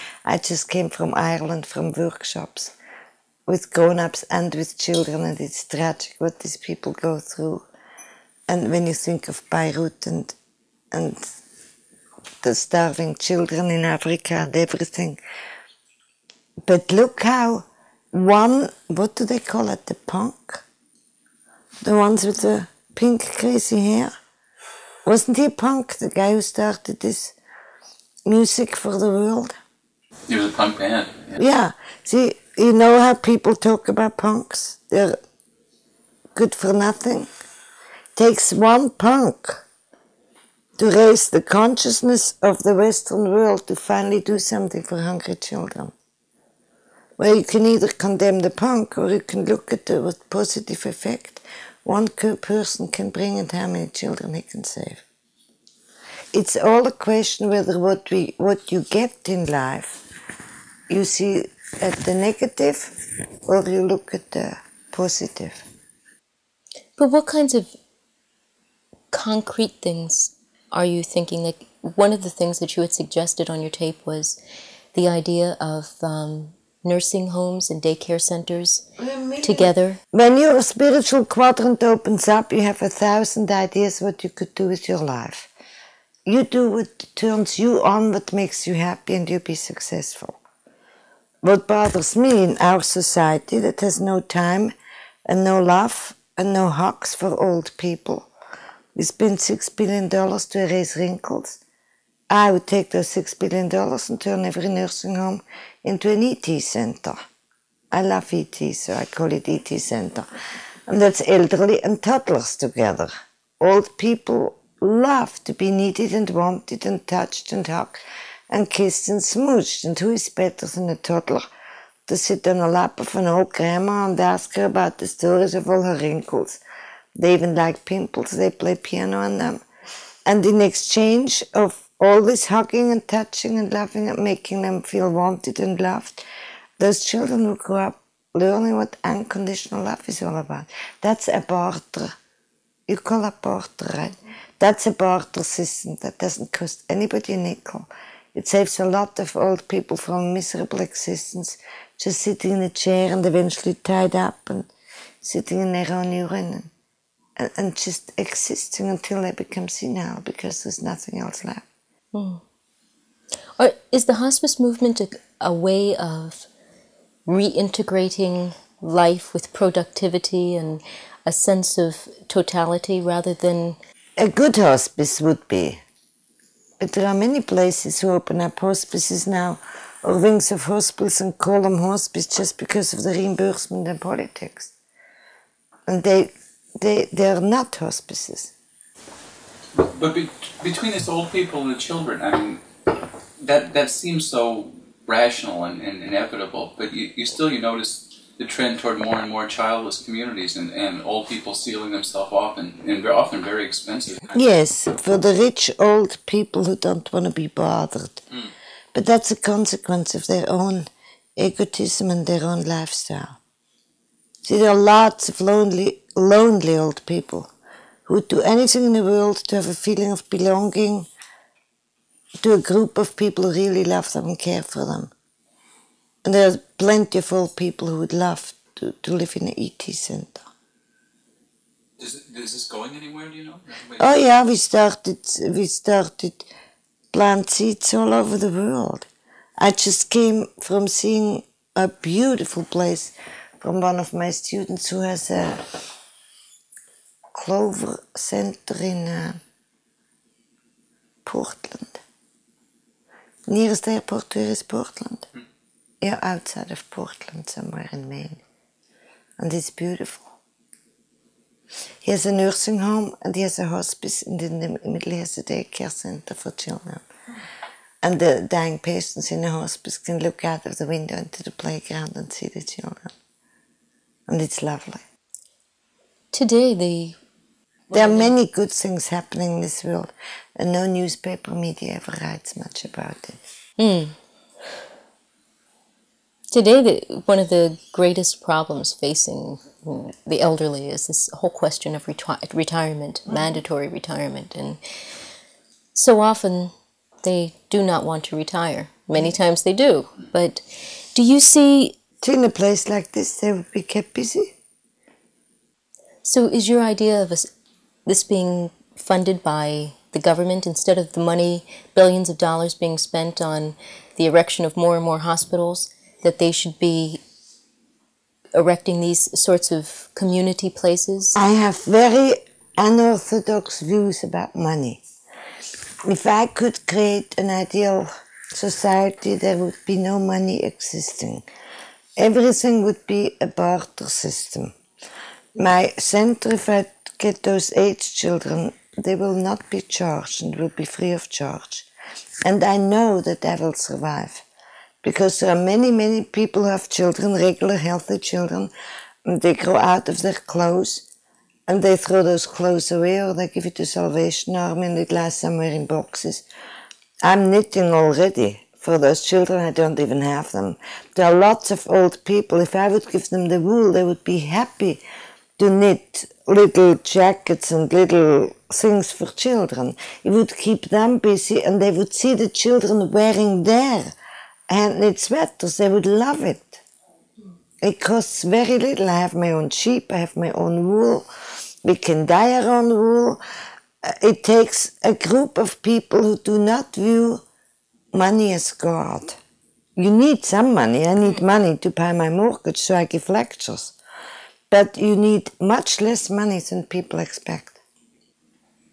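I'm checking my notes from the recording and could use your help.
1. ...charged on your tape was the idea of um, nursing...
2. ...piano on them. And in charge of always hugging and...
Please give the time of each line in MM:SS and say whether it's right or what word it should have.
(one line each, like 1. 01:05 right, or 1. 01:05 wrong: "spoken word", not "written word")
1. 01:12 wrong: "suggested", not "charged"
2. 02:08 wrong: "exchange", not "charge".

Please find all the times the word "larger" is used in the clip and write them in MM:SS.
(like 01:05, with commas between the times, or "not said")
not said.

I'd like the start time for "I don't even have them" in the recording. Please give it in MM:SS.
05:59.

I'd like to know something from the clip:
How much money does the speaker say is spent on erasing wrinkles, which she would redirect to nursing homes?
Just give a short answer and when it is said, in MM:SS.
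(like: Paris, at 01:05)
$6 billion, at 01:39.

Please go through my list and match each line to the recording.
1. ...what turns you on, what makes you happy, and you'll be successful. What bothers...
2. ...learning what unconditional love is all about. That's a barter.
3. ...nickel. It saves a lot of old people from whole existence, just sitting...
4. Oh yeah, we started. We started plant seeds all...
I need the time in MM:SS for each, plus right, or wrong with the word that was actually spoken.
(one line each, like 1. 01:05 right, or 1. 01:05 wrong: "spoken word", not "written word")
1. 01:26 right
2. 02:18 right
3. 02:27 wrong: "miserable", not "whole"
4. 03:53 right.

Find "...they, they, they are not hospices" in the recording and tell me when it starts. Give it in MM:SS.
03:06.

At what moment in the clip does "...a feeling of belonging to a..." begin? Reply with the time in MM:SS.
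03:39.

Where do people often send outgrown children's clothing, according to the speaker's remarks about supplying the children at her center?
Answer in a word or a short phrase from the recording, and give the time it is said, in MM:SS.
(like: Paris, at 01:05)
Salvation Army, at 05:53.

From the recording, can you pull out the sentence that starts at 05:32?
Everything would be a barter system.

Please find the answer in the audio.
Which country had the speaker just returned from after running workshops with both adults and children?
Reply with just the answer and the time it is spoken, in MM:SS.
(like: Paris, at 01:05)
Ireland, at 00:01.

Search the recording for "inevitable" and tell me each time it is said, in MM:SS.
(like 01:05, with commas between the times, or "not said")
03:16.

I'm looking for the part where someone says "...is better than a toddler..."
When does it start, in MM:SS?
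02:00.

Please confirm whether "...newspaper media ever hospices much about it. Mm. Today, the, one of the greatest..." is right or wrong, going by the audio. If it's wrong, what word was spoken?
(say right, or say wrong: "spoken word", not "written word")
wrong: "writes", not "hospices".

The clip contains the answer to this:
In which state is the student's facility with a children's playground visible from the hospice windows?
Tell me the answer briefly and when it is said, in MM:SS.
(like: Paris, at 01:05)
Maine, at 04:18.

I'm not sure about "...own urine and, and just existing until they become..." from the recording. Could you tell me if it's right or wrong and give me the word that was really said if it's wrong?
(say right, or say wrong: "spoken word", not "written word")
right.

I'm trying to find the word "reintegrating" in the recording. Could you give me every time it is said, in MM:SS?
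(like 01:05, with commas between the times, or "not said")
02:47.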